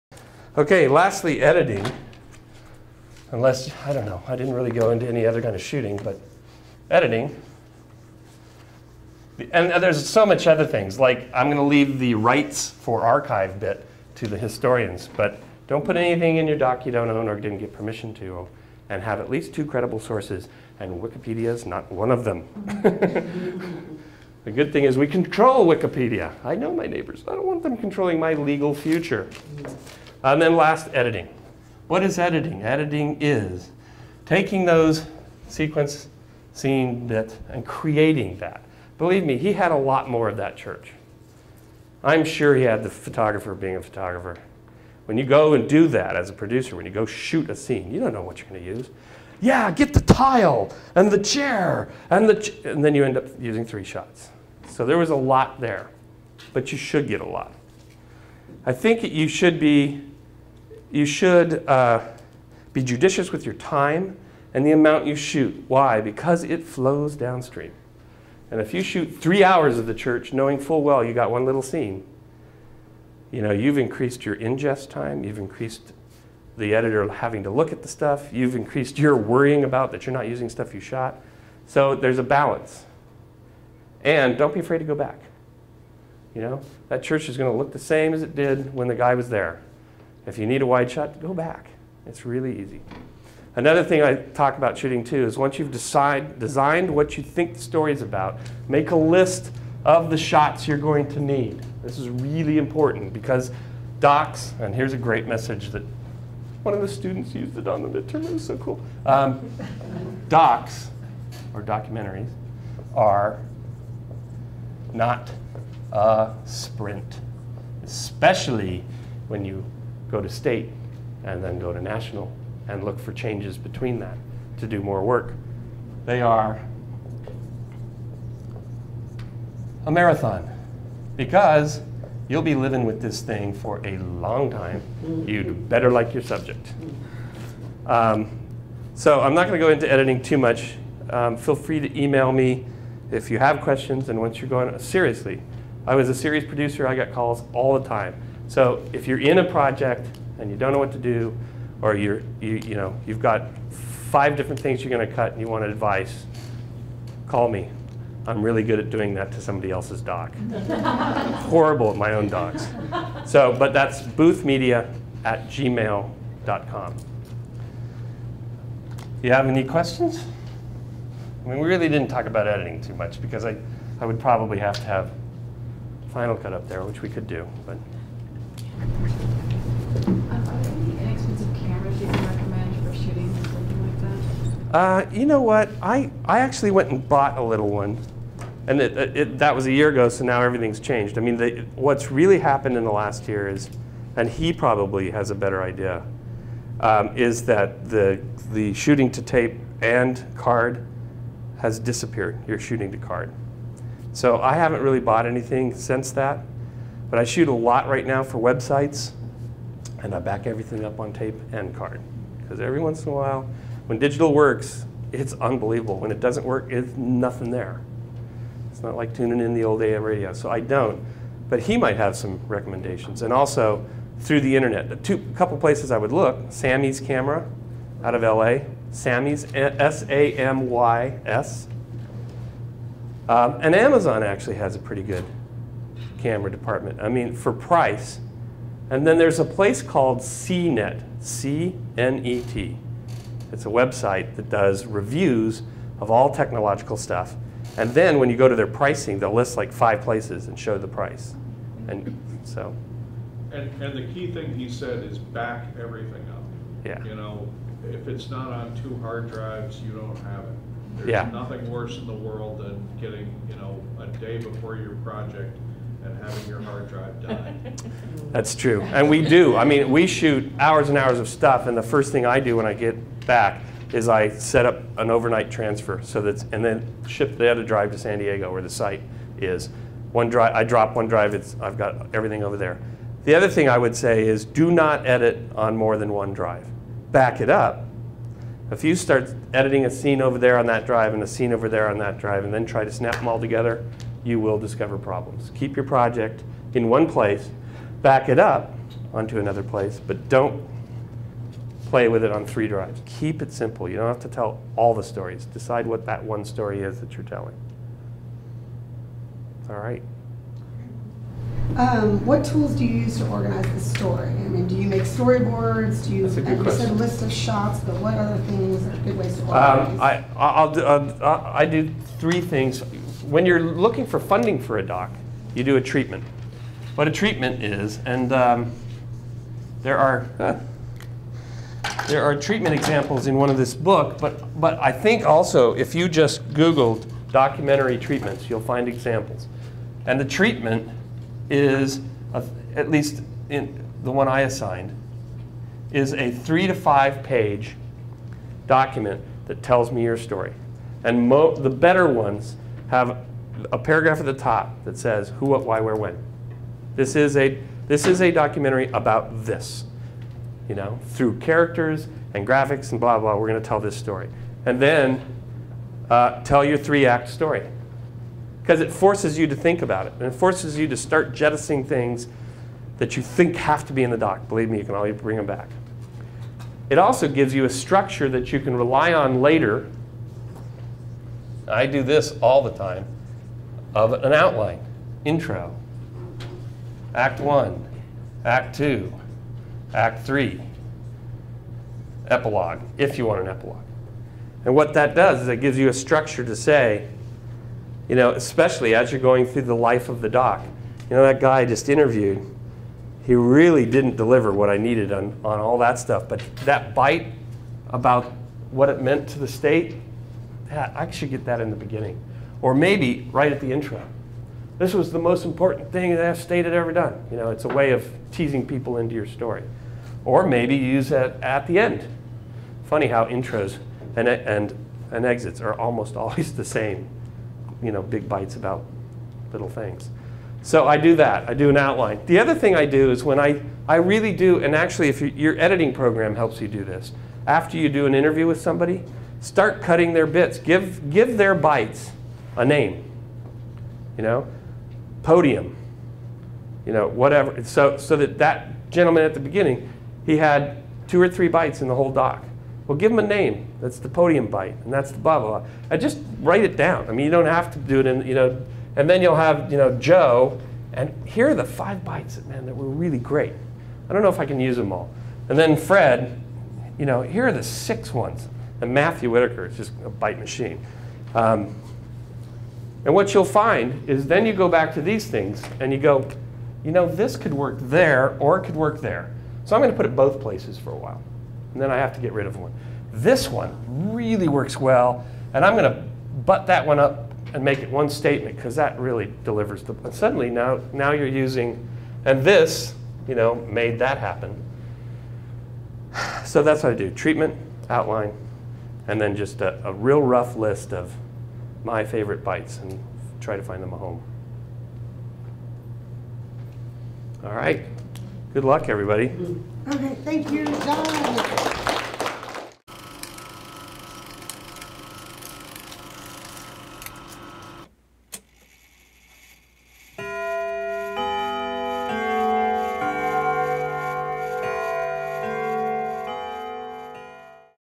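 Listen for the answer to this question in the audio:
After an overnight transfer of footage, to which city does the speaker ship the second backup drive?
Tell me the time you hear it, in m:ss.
4:37.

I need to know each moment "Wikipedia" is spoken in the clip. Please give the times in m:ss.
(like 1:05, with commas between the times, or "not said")
0:21, 0:25.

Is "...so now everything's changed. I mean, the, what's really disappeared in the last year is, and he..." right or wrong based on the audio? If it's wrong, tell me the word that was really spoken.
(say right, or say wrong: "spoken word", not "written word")
wrong: "happened", not "disappeared".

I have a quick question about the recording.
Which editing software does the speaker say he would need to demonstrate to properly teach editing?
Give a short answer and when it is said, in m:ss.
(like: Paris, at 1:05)
Final Cut, at 2:56.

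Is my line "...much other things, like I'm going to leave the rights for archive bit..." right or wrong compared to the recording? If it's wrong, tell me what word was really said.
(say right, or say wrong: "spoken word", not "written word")
right.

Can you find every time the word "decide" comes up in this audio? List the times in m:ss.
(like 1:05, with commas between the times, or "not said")
1:35, 5:05.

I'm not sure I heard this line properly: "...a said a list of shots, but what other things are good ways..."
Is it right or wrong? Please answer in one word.
right.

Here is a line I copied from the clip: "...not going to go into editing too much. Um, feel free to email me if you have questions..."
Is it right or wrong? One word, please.
right.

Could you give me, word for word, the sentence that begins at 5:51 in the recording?
And the better ones have a paragraph at the top that says who, what, why, where, when.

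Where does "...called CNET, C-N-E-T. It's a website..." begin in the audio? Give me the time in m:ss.
3:59.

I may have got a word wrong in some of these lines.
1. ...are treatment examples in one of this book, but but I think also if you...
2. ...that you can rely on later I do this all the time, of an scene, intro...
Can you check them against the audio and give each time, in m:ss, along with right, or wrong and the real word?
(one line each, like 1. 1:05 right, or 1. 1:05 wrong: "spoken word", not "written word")
1. 5:32 right
2. 6:18 wrong: "outline", not "scene".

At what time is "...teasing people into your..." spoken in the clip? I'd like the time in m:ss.
6:58.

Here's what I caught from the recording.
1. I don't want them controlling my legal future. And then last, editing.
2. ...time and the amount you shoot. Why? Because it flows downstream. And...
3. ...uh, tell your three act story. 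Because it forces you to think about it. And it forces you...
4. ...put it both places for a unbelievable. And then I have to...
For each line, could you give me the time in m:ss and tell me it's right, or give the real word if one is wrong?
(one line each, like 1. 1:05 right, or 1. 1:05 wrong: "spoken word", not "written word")
1. 0:27 right
2. 1:03 right
3. 6:06 right
4. 7:59 wrong: "while", not "unbelievable".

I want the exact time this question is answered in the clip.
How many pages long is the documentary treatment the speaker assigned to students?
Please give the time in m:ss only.
5:46.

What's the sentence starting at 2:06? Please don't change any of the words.
They are a marathon because you'll be living with this thing for a long time.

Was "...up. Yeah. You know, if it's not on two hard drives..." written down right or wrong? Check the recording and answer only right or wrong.
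right.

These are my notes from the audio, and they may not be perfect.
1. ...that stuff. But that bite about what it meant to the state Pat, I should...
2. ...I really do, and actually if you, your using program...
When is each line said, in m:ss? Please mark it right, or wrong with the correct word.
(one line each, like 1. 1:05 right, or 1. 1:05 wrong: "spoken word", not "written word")
1. 6:45 right
2. 7:13 wrong: "editing", not "using".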